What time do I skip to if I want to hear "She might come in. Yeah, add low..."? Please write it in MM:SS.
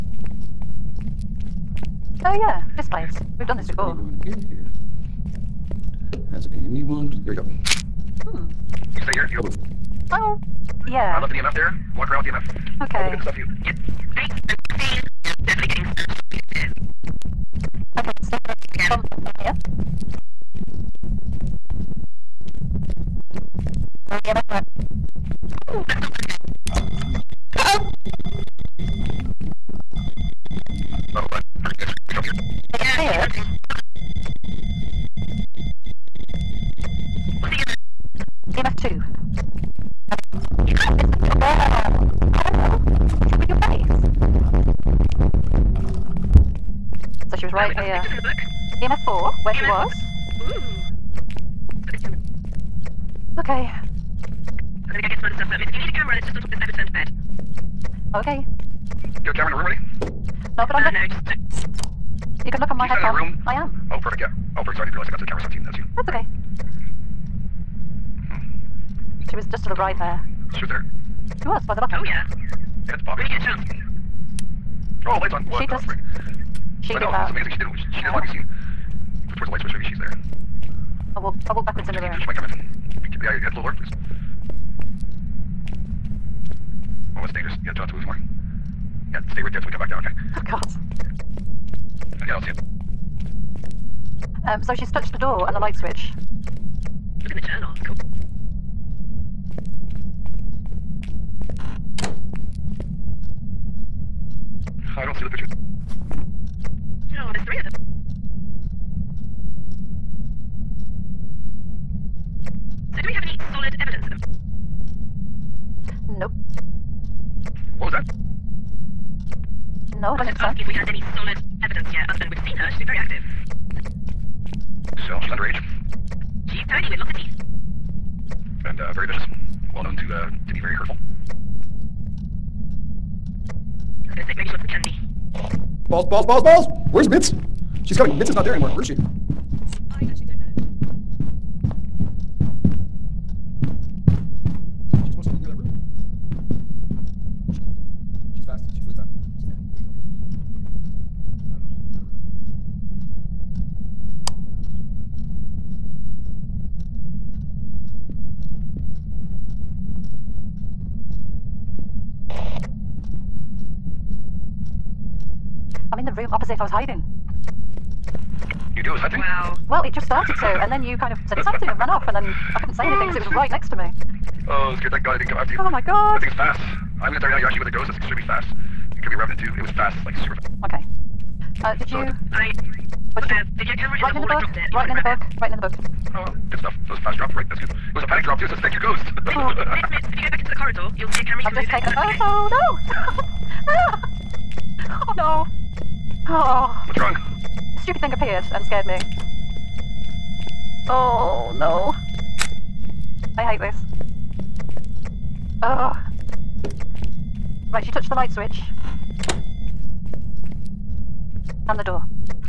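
01:22.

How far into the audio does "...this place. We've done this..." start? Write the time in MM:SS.
00:02.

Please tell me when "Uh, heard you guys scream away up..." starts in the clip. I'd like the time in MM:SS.
00:31.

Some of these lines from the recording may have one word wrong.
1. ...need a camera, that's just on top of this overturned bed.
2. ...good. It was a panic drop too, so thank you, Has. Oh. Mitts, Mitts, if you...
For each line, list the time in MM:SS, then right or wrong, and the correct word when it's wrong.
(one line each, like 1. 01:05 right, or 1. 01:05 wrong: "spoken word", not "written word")
1. 00:55 right
2. 03:07 wrong: "Ghost", not "Has".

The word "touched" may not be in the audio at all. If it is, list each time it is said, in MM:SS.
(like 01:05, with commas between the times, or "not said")
01:34, 03:27.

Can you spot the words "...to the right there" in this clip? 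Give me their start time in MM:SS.
01:09.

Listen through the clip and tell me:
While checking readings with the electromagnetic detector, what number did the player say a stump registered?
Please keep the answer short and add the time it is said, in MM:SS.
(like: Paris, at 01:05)
10, at 00:25.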